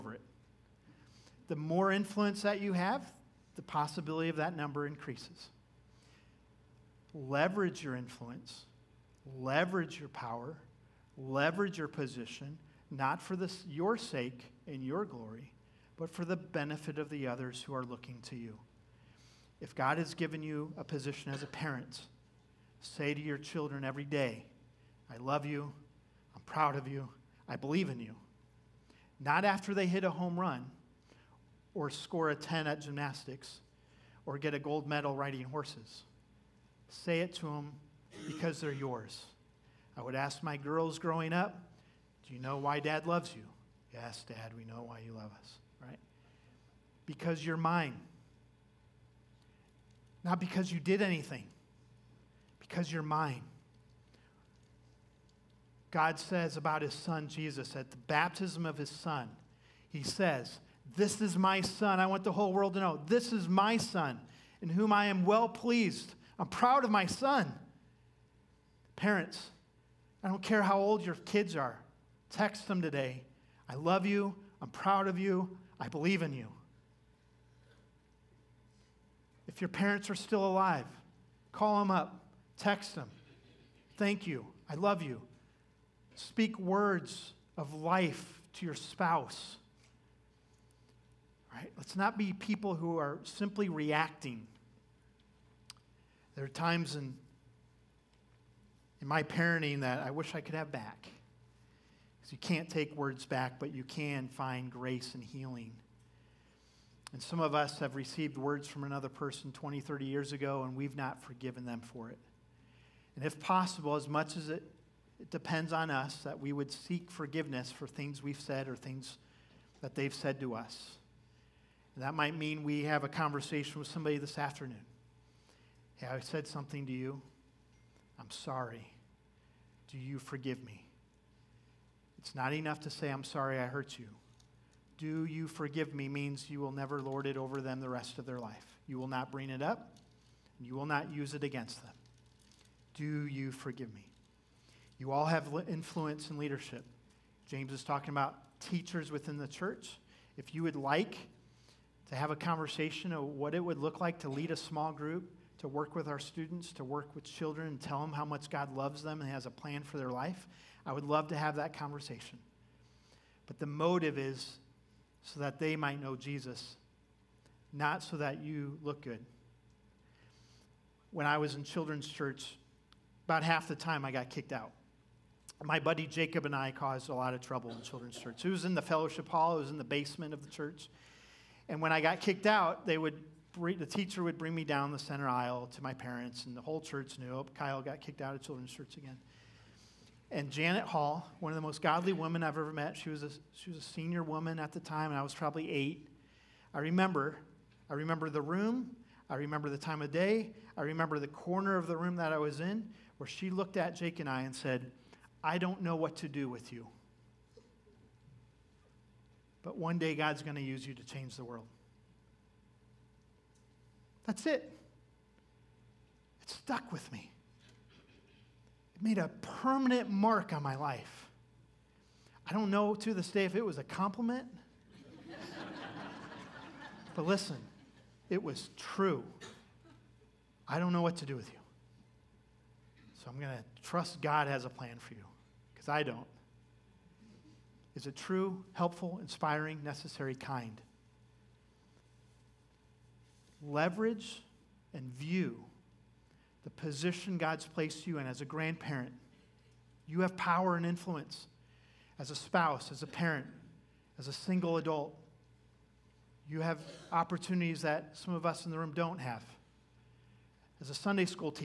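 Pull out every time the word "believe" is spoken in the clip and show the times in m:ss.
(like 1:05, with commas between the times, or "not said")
0:27, 1:15.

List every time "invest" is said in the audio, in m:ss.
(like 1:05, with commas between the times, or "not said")
not said.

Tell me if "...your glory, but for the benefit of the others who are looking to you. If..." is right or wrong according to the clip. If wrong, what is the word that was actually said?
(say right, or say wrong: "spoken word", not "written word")
right.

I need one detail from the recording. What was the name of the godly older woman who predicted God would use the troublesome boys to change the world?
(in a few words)
Janet Hall.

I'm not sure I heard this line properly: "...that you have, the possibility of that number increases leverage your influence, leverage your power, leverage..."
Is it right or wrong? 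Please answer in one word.
right.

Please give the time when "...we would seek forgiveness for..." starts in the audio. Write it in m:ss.
1:56.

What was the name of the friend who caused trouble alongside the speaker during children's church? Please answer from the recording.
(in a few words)
Jacob.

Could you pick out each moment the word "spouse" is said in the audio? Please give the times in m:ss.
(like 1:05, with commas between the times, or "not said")
1:28, 4:12.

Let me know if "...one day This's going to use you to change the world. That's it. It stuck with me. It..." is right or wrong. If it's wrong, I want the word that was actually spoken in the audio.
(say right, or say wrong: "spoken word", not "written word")
wrong: "God", not "This".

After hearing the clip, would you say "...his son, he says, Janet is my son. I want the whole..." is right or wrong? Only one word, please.
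wrong.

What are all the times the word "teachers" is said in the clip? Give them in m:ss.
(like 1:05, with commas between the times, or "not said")
2:28, 3:03.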